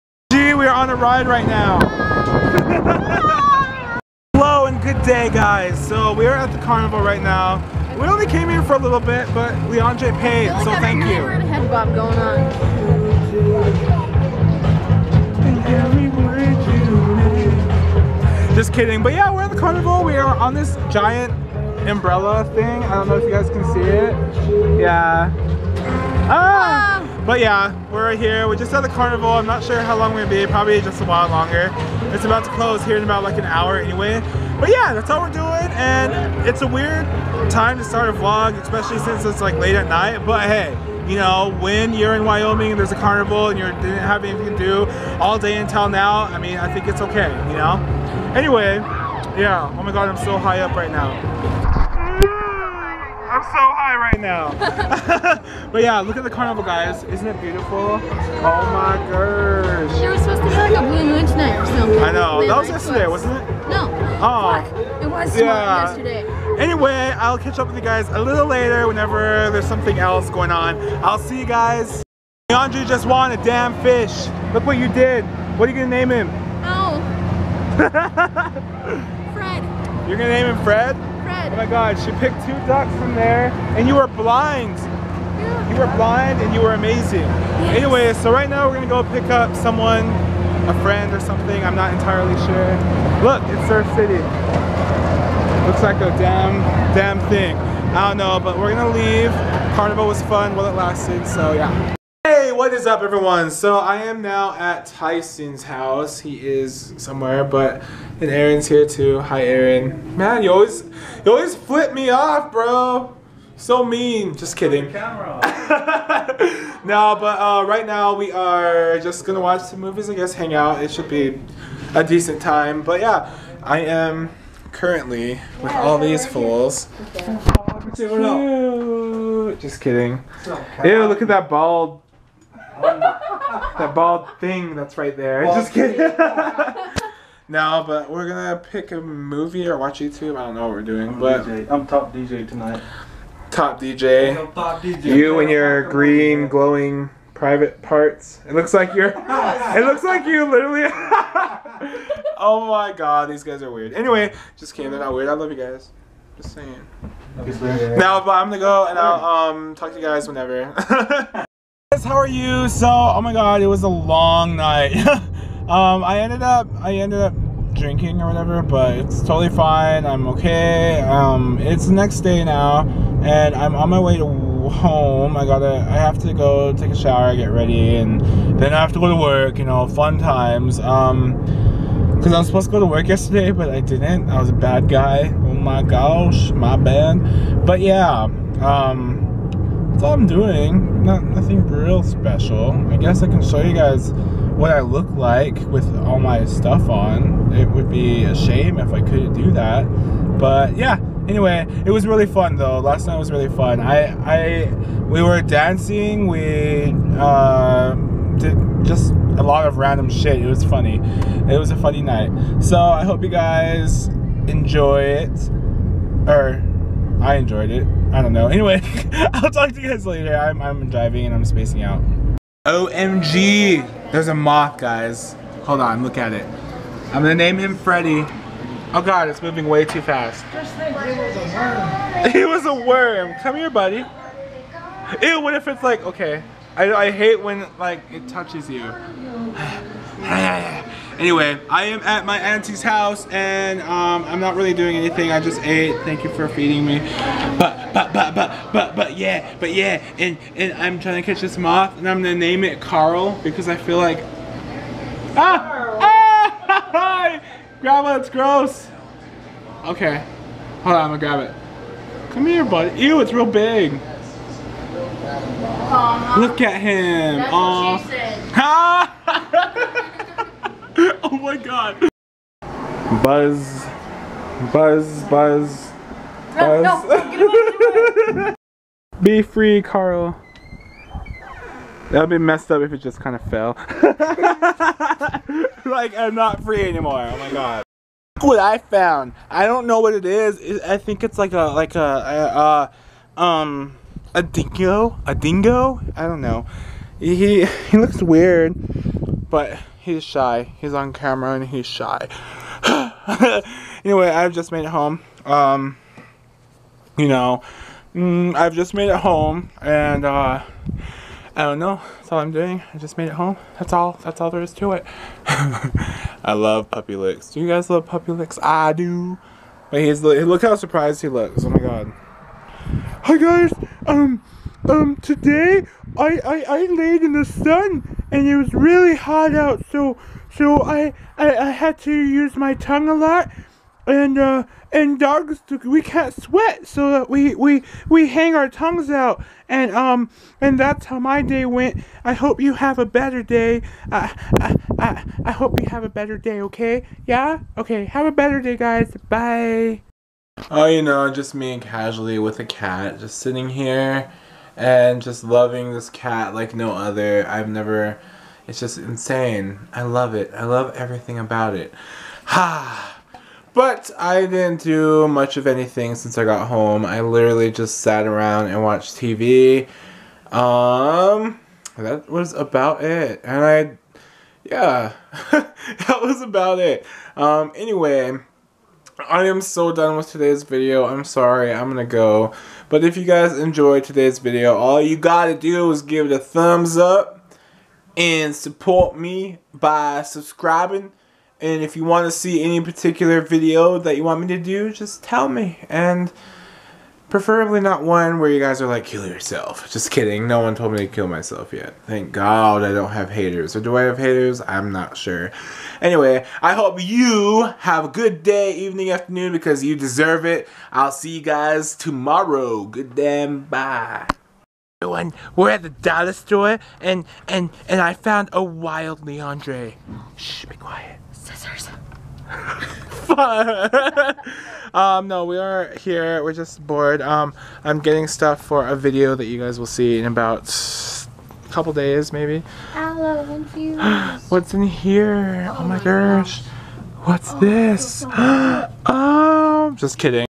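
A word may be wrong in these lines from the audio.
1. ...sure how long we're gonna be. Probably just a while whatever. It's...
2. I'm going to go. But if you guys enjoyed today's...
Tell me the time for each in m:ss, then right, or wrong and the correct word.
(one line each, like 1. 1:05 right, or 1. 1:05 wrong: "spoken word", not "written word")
1. 0:29 wrong: "longer", not "whatever"
2. 6:21 right.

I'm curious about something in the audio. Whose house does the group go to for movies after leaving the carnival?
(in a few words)
Tyson's.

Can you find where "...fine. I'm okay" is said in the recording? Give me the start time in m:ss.
2:49.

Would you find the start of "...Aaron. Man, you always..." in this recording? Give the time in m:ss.
1:49.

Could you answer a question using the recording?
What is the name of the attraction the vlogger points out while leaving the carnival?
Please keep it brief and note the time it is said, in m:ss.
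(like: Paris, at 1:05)
Surf City, at 1:33.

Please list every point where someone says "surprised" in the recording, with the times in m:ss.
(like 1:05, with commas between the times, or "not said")
5:20.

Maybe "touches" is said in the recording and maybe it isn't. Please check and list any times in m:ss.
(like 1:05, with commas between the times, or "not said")
3:58.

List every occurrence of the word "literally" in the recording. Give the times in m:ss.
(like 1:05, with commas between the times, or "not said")
2:30, 6:07.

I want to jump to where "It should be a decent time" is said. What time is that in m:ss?
2:00.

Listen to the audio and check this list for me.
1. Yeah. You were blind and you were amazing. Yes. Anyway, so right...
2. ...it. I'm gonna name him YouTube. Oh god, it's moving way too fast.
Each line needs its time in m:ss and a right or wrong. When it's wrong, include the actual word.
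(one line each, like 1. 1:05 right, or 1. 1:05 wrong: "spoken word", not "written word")
1. 1:24 right
2. 3:46 wrong: "Freddy", not "YouTube".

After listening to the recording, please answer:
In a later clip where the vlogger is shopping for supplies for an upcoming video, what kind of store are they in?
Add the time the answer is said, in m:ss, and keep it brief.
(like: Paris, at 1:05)
dollar store, at 6:55.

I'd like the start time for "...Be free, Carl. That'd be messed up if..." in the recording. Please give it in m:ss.
4:39.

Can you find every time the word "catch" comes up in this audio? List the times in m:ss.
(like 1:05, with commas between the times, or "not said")
1:07, 4:11.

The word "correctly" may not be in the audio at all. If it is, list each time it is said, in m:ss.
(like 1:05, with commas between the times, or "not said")
not said.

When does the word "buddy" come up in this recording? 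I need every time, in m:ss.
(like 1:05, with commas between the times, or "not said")
3:53, 4:22.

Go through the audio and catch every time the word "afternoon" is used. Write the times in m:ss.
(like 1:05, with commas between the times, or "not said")
6:49.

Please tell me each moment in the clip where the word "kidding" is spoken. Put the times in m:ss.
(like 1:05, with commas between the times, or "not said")
0:18, 1:54, 2:09, 2:15, 2:34, 6:40, 7:20.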